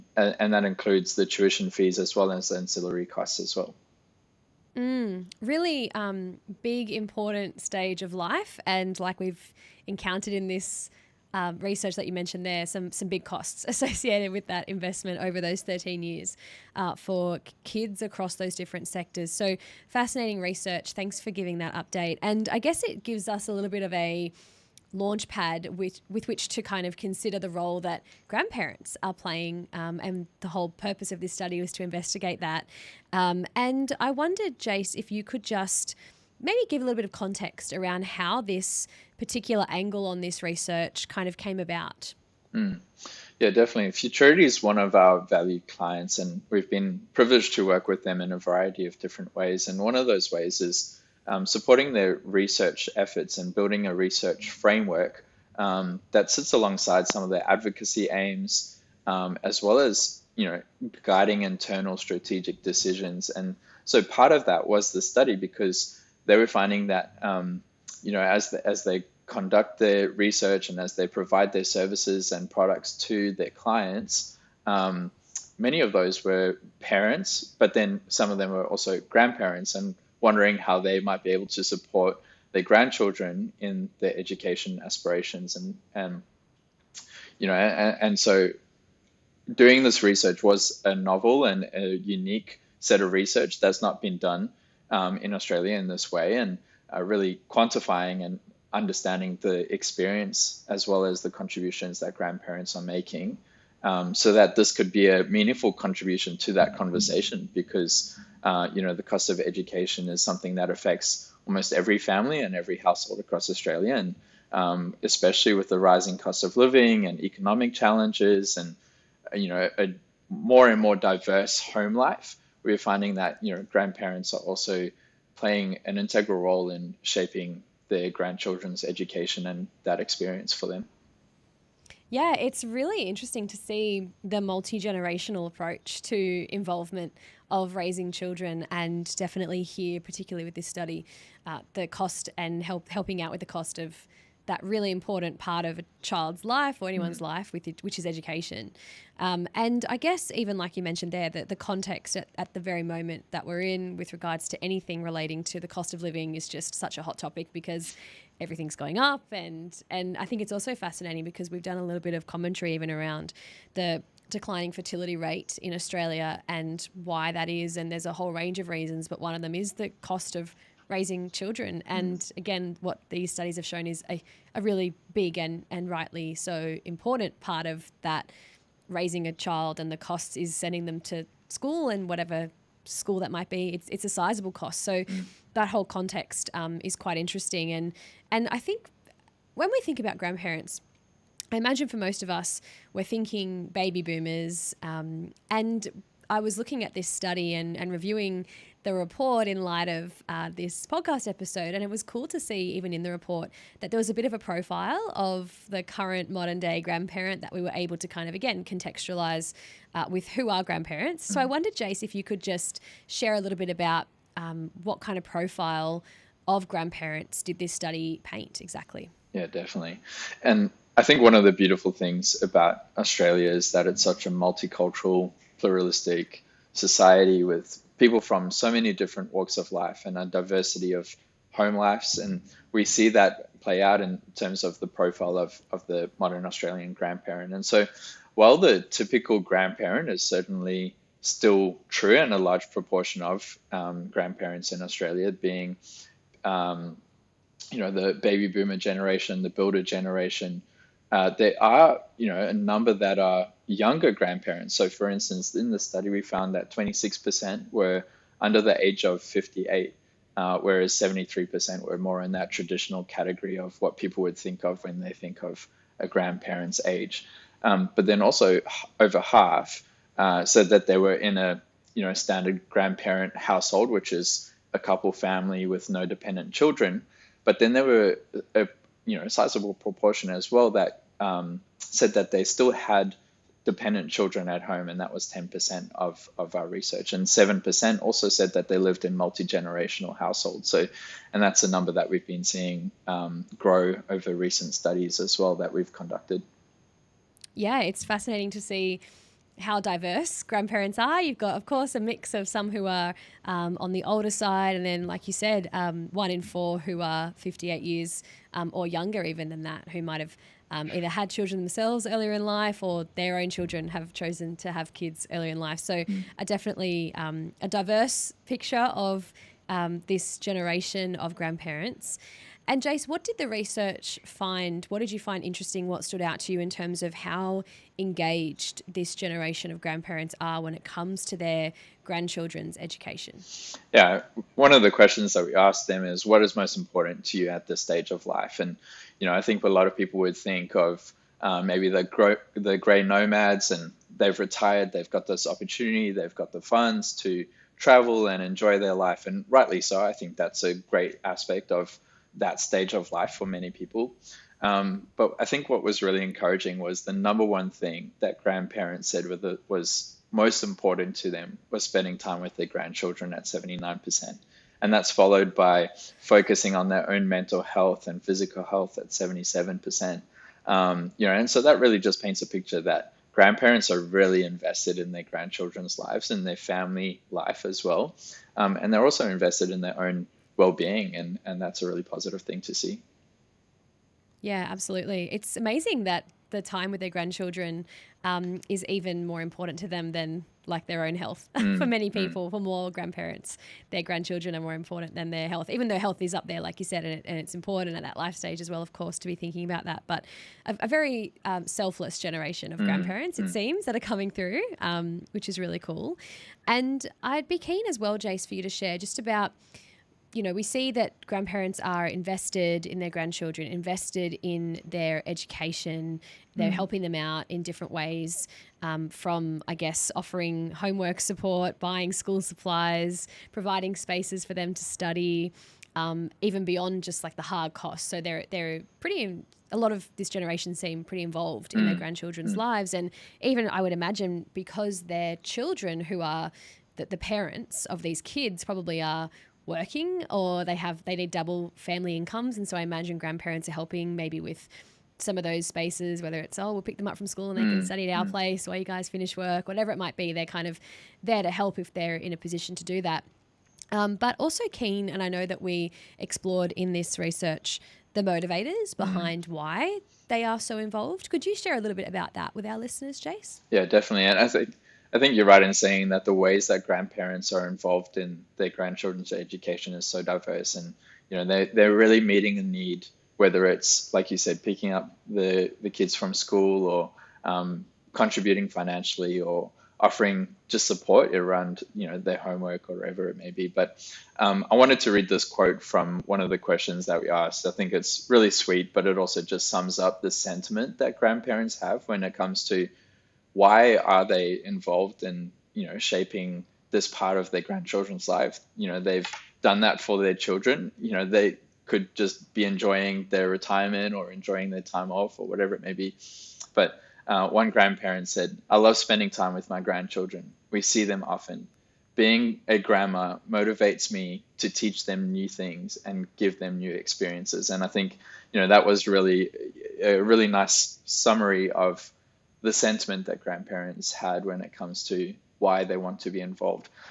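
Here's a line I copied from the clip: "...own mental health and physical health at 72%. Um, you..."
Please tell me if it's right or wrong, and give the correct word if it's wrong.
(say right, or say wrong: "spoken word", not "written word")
wrong: "77", not "72".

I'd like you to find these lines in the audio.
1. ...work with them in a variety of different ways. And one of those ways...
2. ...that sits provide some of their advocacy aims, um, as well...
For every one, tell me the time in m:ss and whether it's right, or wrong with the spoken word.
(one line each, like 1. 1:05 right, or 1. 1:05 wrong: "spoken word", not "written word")
1. 0:47 right
2. 0:56 wrong: "alongside", not "provide".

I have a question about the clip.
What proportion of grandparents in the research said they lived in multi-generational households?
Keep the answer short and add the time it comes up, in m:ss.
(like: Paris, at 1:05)
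7%, at 4:47.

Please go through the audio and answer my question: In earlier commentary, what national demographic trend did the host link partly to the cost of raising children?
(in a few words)
Declining fertility rate.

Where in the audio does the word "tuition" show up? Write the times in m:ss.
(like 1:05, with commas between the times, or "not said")
0:01.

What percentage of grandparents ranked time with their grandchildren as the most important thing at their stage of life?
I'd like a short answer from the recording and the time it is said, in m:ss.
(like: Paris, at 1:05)
79%, at 6:03.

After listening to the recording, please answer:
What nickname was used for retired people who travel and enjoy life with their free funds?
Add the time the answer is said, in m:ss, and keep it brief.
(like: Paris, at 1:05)
Gray nomads, at 5:42.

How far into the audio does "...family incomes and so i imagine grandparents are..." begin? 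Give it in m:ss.
7:21.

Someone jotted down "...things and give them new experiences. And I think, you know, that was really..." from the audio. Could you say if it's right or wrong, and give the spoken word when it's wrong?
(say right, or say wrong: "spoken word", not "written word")
right.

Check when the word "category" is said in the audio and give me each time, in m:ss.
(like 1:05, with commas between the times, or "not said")
4:23.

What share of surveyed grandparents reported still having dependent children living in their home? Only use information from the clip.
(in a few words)
10%.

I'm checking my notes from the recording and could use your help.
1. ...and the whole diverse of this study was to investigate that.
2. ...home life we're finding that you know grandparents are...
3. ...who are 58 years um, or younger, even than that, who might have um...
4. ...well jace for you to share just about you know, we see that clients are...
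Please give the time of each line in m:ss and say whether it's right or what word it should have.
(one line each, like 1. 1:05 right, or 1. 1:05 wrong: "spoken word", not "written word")
1. 0:30 wrong: "purpose", not "diverse"
2. 2:01 right
3. 5:06 right
4. 6:47 wrong: "grandparents", not "clients".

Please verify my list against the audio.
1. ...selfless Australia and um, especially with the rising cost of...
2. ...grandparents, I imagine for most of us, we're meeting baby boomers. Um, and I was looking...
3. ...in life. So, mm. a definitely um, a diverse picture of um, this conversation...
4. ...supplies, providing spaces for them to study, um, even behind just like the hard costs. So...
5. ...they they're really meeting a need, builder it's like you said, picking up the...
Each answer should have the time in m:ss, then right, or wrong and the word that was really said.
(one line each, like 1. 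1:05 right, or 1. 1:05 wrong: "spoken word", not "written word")
1. 1:53 wrong: "across", not "selfless"
2. 3:10 wrong: "thinking", not "meeting"
3. 5:15 wrong: "generation", not "conversation"
4. 7:02 wrong: "beyond", not "behind"
5. 7:51 wrong: "whether", not "builder".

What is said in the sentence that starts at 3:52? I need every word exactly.
And we see that play out in terms of the profile of, of the modern Australian grandparent.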